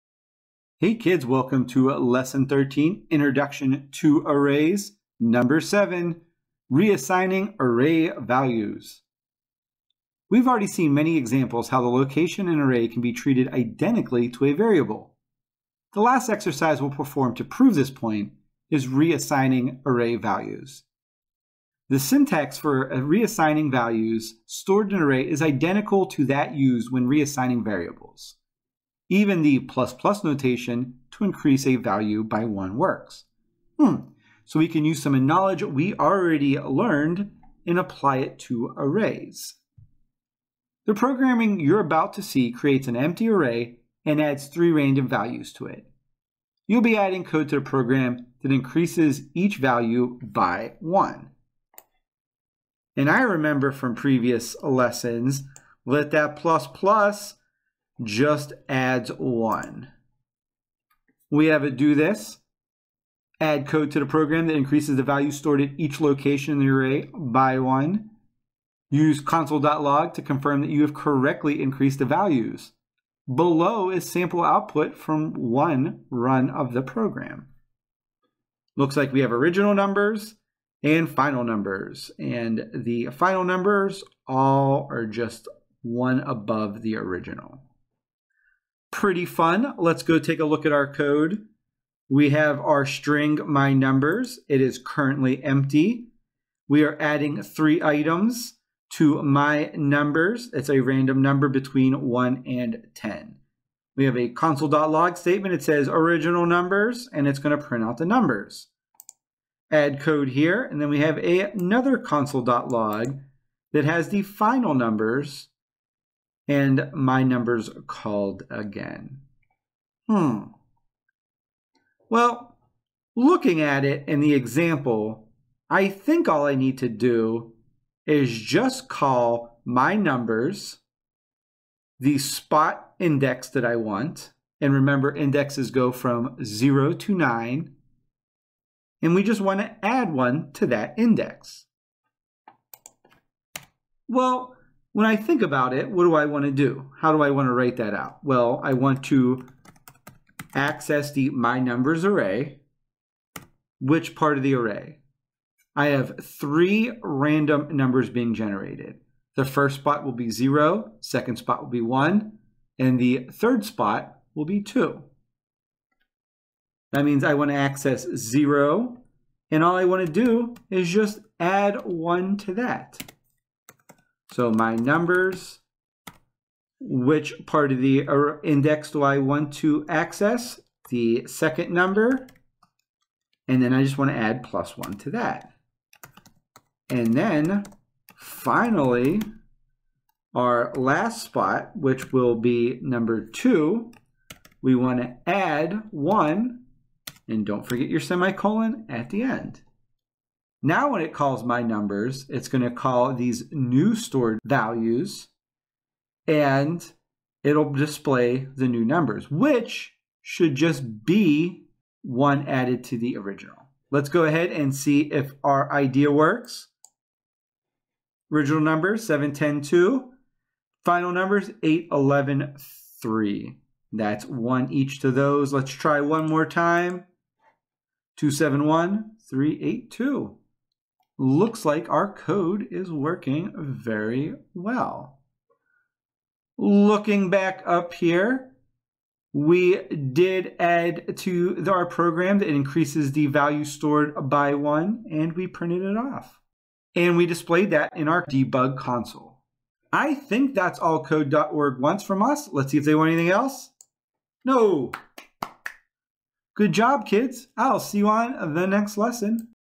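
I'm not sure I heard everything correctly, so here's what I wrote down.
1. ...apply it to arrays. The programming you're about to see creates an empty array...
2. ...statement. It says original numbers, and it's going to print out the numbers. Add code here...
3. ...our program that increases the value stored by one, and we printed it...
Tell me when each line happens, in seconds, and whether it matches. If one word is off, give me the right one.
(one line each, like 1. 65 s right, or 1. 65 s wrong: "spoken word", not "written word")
1. 37 s right
2. 105 s right
3. 241 s right.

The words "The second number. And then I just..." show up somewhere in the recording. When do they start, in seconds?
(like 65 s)
180 s.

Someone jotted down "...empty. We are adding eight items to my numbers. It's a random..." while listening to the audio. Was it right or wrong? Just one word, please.
wrong.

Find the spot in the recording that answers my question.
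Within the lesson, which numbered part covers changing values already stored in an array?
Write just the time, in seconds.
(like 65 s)
5 s.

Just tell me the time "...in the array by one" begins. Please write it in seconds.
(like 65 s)
66 s.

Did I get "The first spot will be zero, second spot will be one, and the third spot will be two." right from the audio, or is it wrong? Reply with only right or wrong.
right.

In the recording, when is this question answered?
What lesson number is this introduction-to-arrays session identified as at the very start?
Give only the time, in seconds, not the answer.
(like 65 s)
1 s.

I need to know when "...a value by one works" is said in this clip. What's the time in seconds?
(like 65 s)
31 s.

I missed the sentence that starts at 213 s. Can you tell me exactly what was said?
Let's go ahead and see if our idea works.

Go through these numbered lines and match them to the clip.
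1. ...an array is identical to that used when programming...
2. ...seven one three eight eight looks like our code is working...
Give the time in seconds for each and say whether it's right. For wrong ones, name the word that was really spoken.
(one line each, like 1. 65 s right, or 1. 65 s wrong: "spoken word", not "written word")
1. 24 s wrong: "reassigning", not "programming"
2. 228 s wrong: "two", not "eight".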